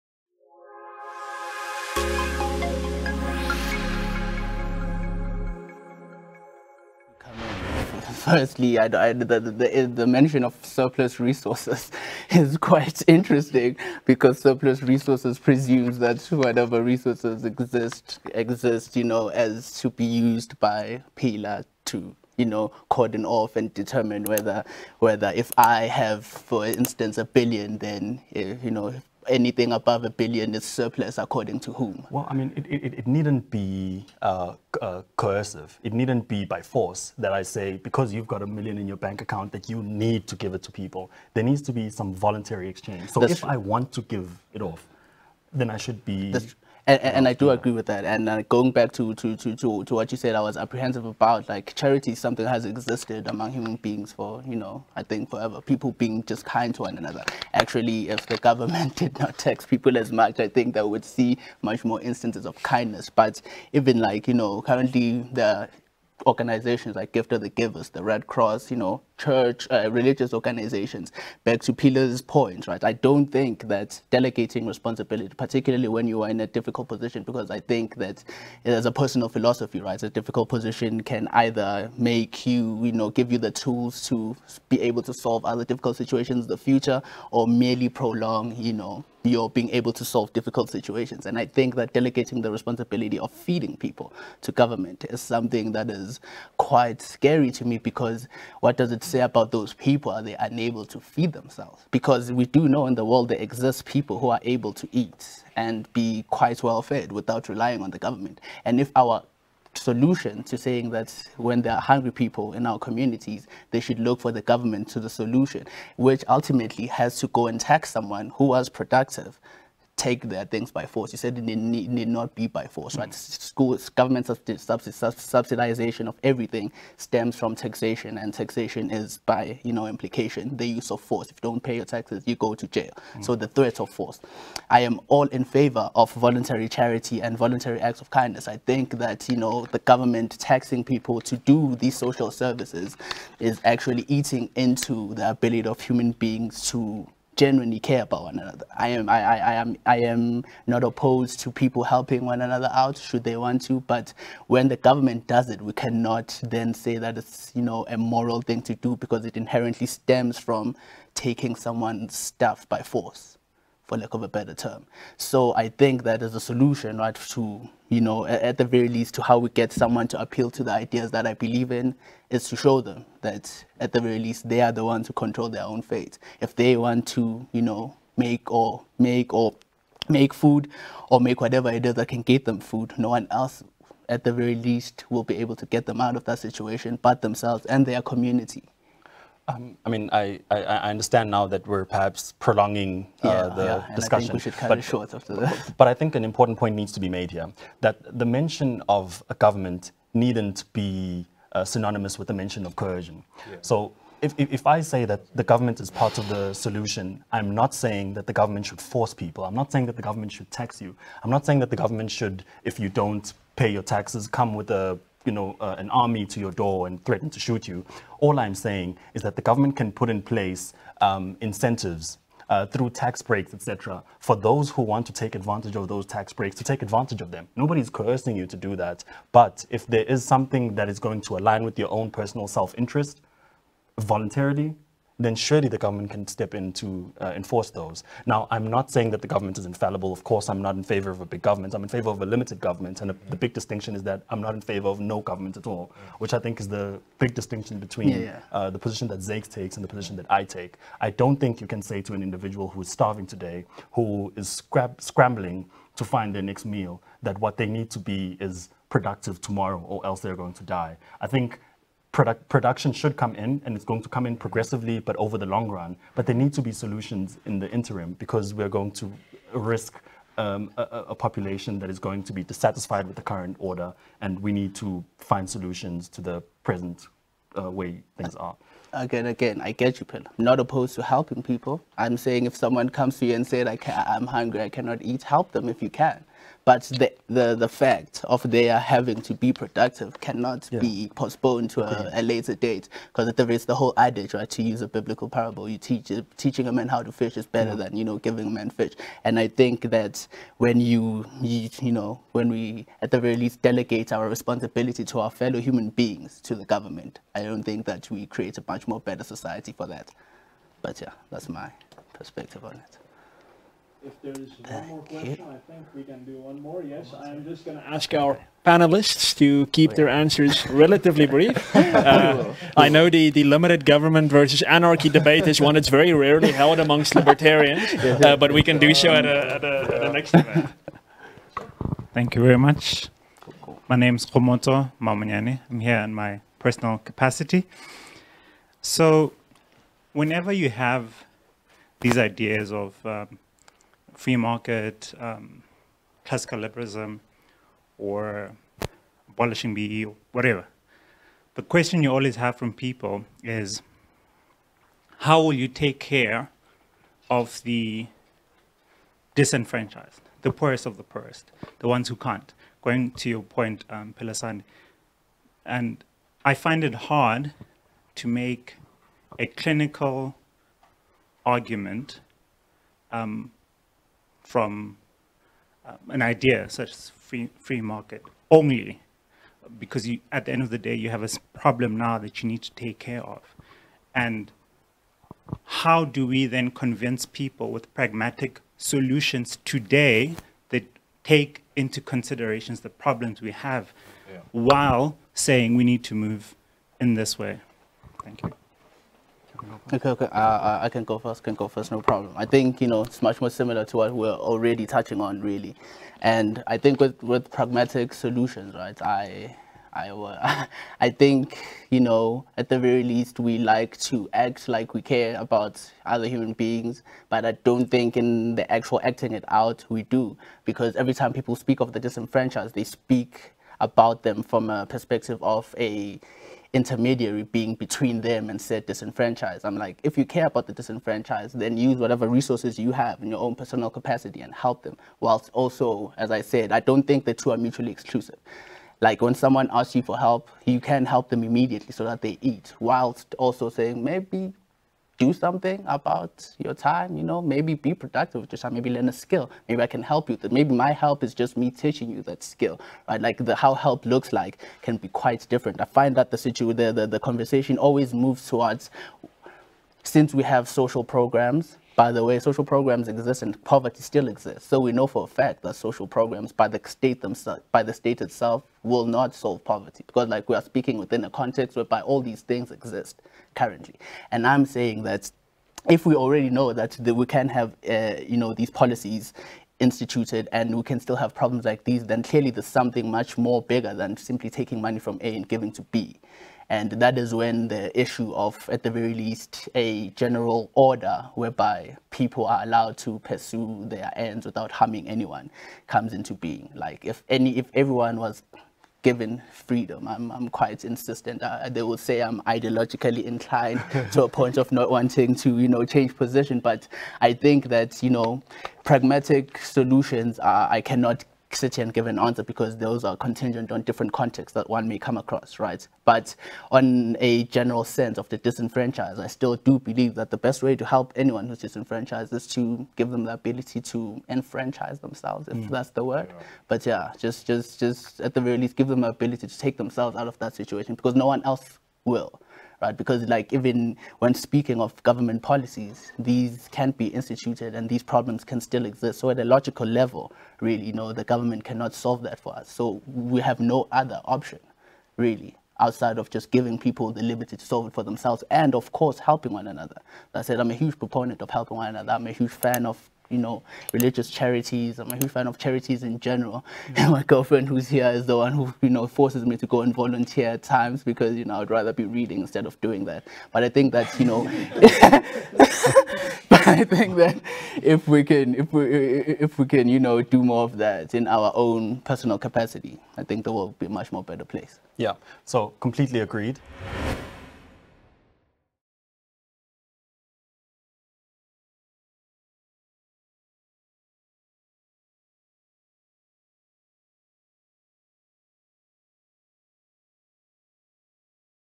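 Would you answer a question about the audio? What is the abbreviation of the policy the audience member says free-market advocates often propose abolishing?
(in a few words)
BEE.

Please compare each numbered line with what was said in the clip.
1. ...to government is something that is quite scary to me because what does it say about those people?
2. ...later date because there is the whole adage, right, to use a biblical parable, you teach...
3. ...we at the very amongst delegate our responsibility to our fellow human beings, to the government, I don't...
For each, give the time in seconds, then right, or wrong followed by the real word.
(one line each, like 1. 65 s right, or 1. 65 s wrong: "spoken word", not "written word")
1. 94 s right
2. 292 s right
3. 302 s wrong: "least", not "amongst".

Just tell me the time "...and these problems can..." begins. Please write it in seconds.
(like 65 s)
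537 s.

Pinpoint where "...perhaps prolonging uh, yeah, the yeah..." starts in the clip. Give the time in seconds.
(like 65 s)
191 s.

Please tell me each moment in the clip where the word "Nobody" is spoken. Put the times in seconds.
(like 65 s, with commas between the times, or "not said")
227 s.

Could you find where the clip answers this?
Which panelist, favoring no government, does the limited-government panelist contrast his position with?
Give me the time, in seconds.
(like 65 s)
249 s.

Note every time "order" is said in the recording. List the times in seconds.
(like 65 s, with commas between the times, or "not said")
273 s, 490 s.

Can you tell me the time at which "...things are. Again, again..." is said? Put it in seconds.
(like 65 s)
278 s.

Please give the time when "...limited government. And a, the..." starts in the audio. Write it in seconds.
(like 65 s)
242 s.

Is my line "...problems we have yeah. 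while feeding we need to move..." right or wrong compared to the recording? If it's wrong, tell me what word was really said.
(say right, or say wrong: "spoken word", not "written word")
wrong: "saying", not "feeding".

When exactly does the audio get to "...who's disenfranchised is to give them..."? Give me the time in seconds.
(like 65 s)
521 s.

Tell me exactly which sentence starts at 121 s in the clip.
You said it need, need not be by force, right?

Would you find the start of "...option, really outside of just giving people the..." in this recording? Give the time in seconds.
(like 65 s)
544 s.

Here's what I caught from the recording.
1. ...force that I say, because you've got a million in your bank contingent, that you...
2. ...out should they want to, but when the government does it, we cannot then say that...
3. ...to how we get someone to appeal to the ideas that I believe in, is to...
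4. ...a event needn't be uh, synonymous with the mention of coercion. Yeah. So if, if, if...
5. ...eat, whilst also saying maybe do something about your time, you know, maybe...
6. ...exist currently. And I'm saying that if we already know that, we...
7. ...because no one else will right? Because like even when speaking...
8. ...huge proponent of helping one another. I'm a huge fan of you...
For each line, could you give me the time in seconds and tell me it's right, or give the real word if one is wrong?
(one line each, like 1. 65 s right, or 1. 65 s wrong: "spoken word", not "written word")
1. 36 s wrong: "account", not "contingent"
2. 152 s right
3. 169 s right
4. 199 s wrong: "government", not "event"
5. 442 s right
6. 472 s right
7. 530 s right
8. 550 s right.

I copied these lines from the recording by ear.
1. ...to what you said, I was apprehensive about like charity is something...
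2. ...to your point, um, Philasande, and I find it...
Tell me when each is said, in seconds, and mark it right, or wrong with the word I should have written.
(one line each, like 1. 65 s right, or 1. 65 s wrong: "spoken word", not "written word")
1. 49 s right
2. 363 s right.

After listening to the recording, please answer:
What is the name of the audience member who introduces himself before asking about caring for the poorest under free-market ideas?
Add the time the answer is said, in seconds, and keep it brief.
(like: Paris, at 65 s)
Komoto Mamanyane, at 334 s.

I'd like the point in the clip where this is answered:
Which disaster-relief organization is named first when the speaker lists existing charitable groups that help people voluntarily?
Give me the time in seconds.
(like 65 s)
67 s.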